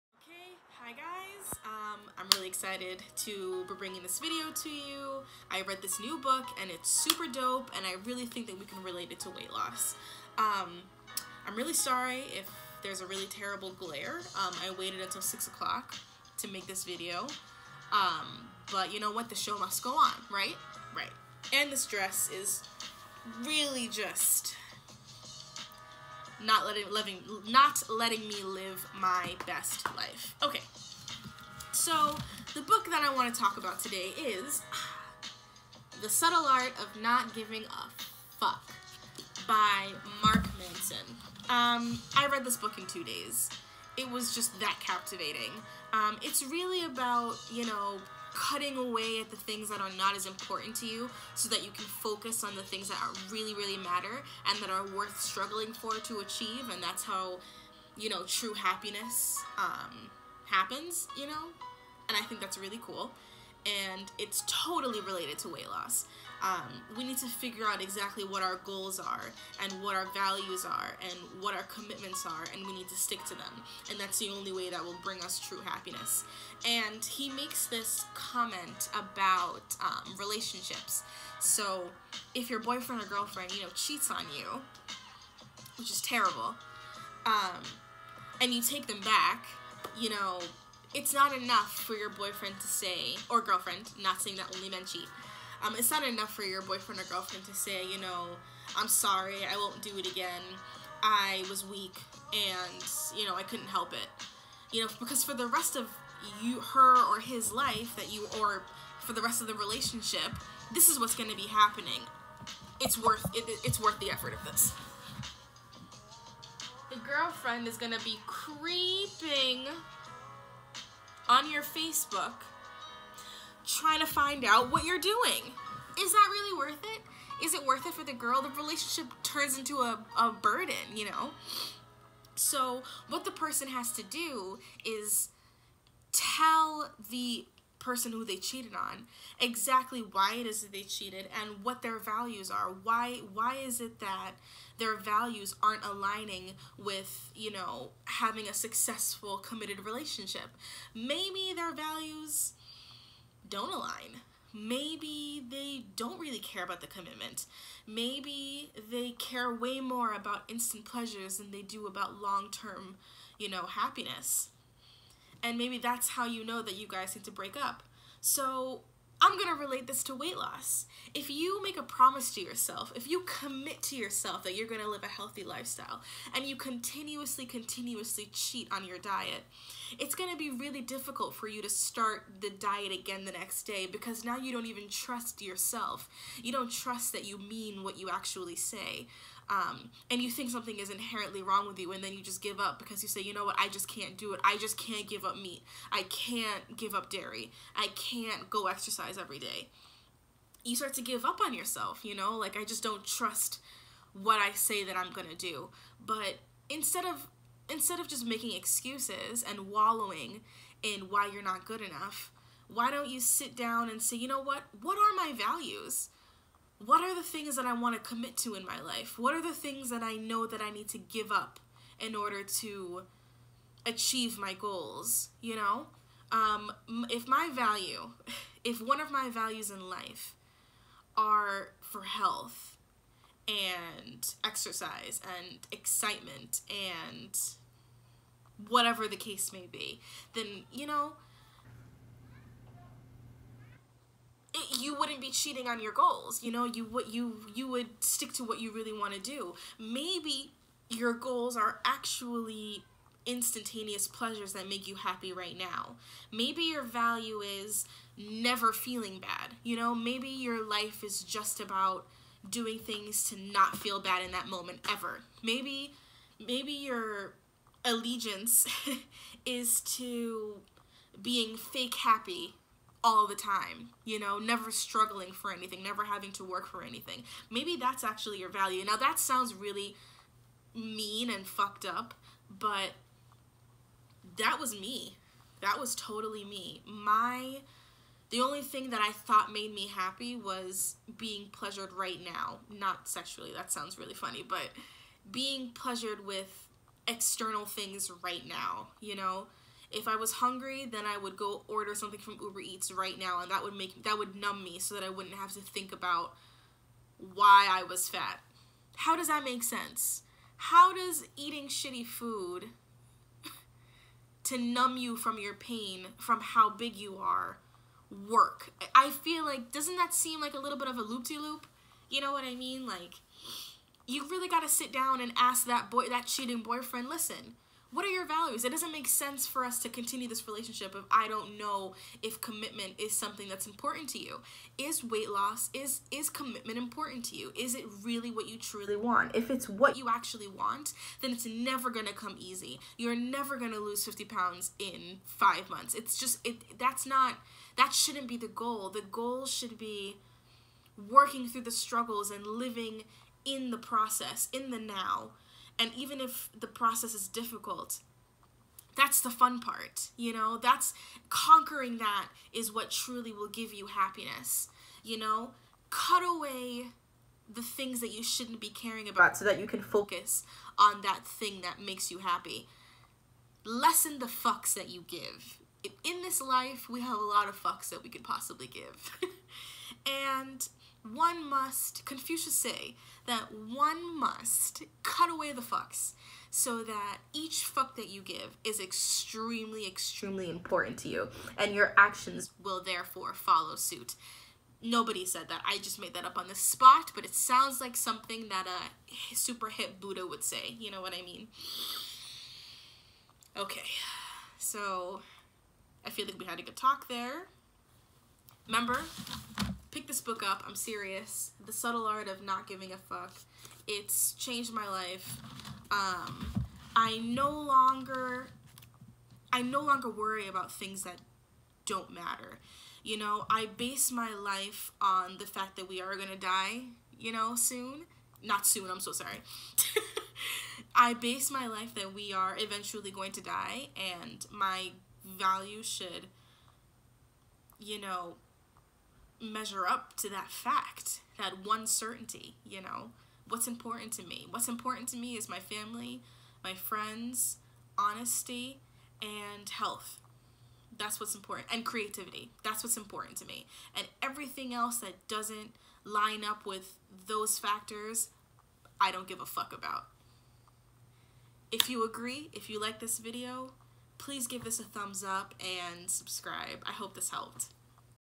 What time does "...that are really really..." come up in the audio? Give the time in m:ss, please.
0:52.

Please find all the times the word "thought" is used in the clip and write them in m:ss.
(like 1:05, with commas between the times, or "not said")
4:49.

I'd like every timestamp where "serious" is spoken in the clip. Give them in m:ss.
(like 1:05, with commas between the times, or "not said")
6:50.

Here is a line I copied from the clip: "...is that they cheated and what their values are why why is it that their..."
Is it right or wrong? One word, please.
right.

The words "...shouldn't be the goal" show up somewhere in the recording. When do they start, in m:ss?
5:47.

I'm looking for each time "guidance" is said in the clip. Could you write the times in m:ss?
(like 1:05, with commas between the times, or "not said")
not said.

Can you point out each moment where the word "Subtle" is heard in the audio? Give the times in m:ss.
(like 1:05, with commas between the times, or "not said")
0:36, 6:51.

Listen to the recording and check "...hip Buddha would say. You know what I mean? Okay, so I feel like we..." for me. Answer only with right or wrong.
right.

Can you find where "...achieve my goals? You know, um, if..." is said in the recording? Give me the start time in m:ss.
3:43.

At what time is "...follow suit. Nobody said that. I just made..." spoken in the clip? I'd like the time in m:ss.
6:33.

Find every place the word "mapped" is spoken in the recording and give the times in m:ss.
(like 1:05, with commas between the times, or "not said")
not said.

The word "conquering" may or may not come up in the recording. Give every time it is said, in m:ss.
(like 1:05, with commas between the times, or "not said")
6:01.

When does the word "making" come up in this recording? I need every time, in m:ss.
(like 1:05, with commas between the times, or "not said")
3:28.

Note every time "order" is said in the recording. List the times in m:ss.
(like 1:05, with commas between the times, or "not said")
3:42, 5:01.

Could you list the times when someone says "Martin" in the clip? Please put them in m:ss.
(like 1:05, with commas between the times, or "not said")
not said.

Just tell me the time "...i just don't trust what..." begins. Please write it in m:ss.
3:22.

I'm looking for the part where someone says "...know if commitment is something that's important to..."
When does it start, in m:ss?
5:31.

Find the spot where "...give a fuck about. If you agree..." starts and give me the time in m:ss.
7:39.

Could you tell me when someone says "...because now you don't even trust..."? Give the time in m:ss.
3:03.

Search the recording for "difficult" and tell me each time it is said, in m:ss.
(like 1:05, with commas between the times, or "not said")
3:00, 5:57.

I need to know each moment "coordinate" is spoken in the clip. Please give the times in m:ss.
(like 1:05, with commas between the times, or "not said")
not said.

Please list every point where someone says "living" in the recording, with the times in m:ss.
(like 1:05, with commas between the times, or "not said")
0:26, 5:52.